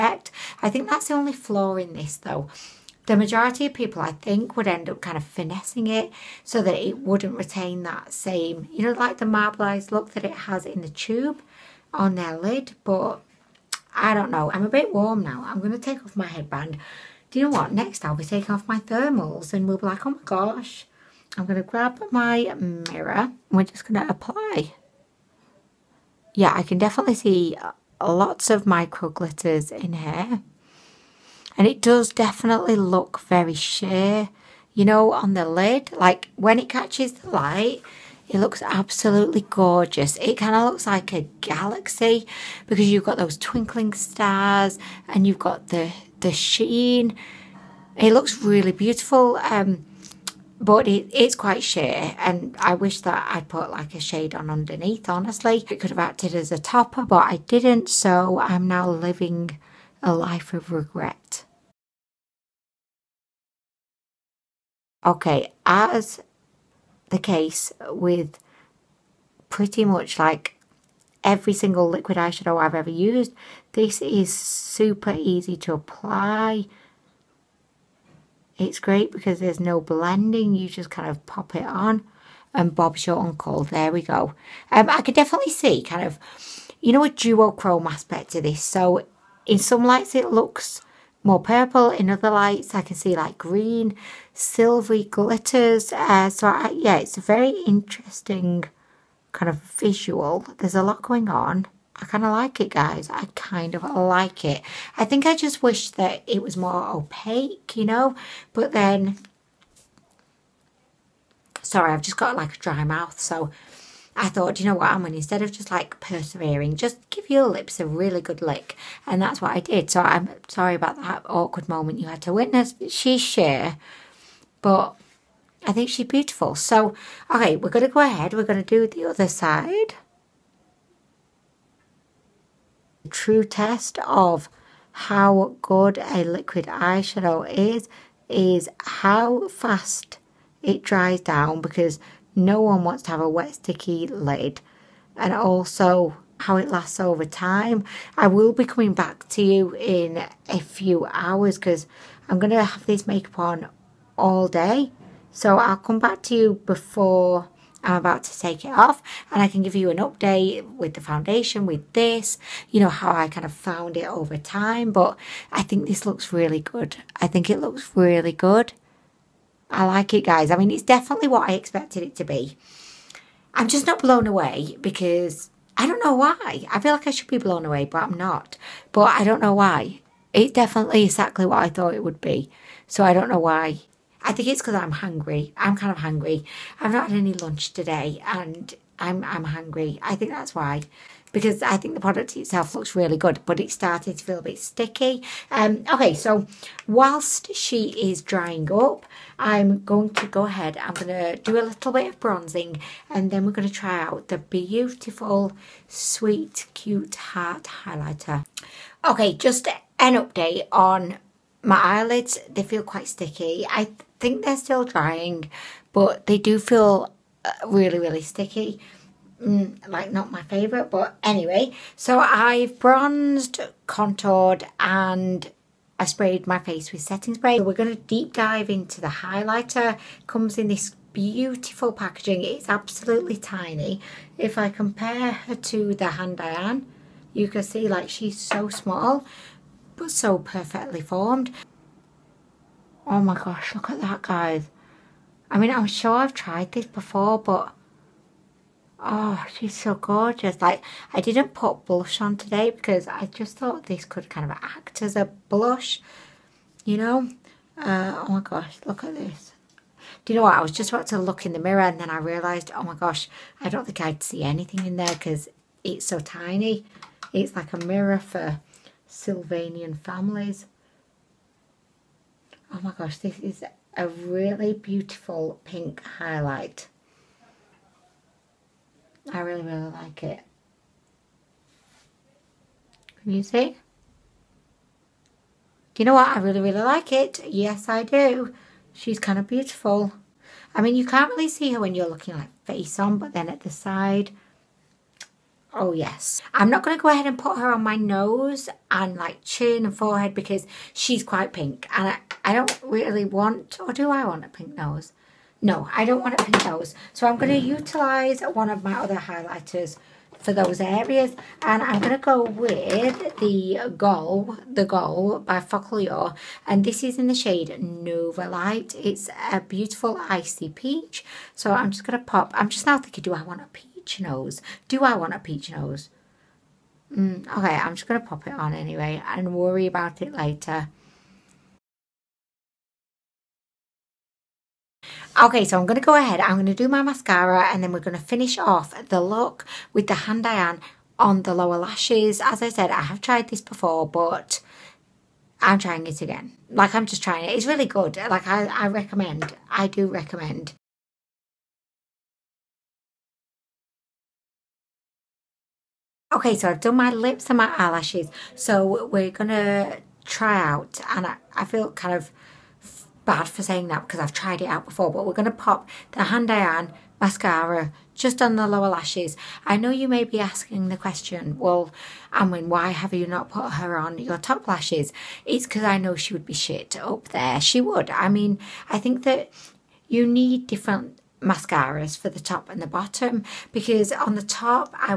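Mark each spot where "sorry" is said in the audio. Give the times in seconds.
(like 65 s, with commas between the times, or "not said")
111 s, 120 s.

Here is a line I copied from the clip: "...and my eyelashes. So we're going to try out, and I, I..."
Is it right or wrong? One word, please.
right.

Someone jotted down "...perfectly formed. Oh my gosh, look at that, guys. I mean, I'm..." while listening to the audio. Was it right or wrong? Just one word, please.
right.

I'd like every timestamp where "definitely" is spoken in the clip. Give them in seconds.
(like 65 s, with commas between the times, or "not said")
26 s, 32 s, 85 s, 170 s, 180 s.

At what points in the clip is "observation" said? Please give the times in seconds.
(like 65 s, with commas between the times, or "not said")
not said.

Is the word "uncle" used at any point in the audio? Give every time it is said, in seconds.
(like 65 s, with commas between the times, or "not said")
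83 s.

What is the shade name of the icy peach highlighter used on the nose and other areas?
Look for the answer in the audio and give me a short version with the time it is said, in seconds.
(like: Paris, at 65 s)
Nova Light, at 317 s.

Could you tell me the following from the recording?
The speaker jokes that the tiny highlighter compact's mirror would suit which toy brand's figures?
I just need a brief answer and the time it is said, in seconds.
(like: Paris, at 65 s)
Sylvanian Families, at 269 s.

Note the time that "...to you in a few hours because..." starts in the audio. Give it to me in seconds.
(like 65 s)
149 s.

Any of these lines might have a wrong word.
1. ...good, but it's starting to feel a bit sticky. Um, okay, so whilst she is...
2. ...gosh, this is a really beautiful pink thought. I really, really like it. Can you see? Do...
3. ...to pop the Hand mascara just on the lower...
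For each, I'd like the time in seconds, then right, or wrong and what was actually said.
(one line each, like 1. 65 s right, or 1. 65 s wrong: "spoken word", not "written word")
1. 193 s right
2. 272 s wrong: "highlight", not "thought"
3. 365 s right.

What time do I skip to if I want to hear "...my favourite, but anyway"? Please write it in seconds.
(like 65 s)
220 s.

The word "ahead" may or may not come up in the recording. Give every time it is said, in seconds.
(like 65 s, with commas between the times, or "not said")
127 s, 200 s, 297 s, 336 s.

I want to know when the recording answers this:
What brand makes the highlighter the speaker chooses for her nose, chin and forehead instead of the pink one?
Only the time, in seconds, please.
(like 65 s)
315 s.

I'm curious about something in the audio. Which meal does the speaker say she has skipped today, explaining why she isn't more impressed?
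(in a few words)
lunch.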